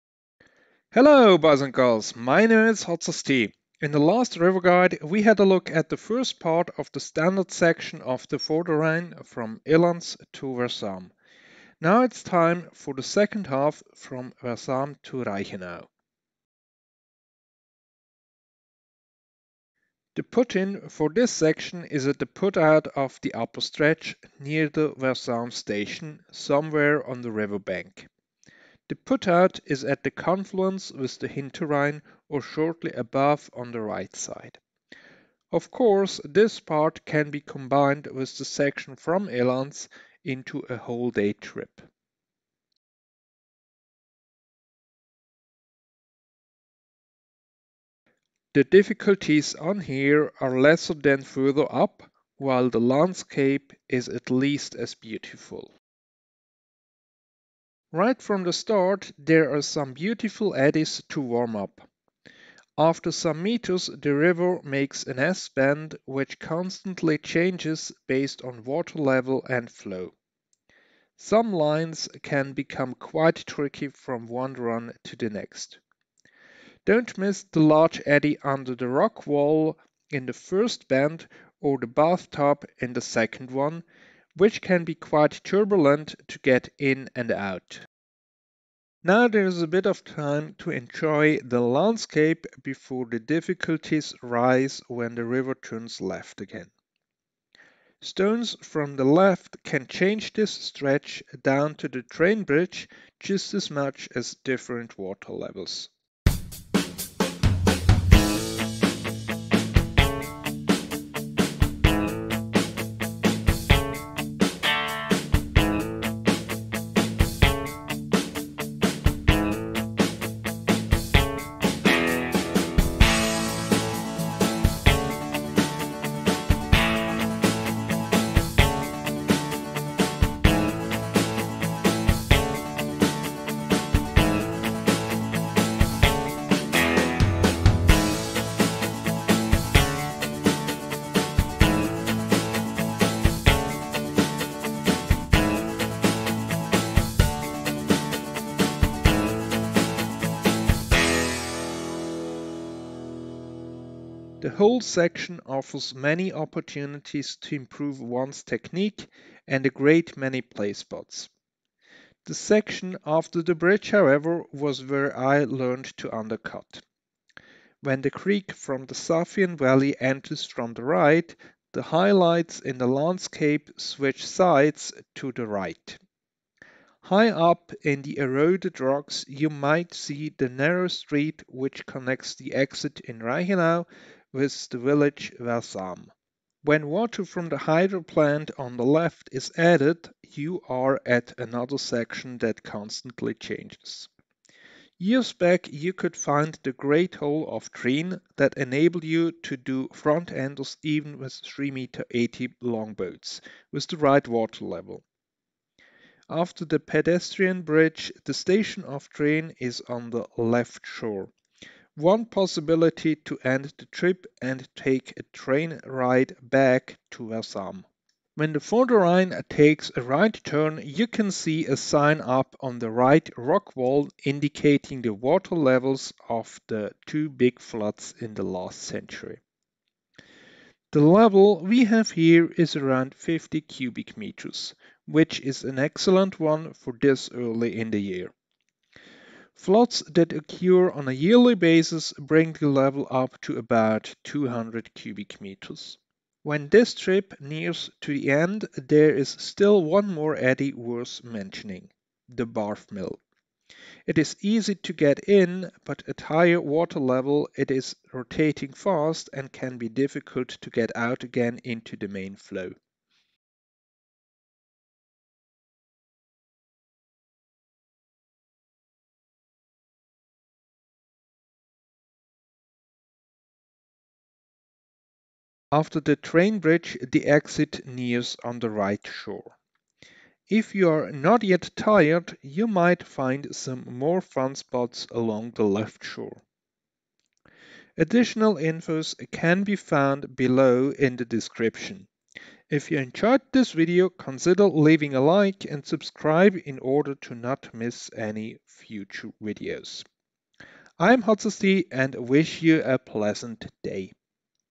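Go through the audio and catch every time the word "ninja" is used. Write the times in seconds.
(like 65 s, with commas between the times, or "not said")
not said.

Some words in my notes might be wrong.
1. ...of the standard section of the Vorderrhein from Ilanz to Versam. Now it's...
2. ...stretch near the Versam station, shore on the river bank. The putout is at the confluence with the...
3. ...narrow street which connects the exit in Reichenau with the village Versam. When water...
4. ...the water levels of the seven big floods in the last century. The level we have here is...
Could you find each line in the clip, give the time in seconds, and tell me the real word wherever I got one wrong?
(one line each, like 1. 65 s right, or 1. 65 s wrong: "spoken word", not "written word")
1. 6 s right
2. 23 s wrong: "somewhere", not "shore"
3. 180 s right
4. 225 s wrong: "two", not "seven".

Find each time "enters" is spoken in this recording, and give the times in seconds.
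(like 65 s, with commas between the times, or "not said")
169 s.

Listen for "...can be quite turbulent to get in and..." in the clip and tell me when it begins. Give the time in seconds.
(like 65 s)
84 s.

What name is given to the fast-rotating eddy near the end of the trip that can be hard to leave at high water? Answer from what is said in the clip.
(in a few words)
Barf Mill.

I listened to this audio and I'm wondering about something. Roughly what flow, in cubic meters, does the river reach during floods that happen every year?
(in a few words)
200.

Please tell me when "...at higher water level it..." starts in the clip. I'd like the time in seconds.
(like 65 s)
256 s.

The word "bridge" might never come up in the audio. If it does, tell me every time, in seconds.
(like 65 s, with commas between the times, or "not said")
102 s, 163 s, 207 s, 276 s.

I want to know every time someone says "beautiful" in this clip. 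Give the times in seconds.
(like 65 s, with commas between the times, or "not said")
54 s, 59 s.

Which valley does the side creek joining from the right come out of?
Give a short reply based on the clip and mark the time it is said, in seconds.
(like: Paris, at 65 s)
Safien Valley, at 168 s.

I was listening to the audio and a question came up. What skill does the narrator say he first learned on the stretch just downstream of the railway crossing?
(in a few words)
To undercut.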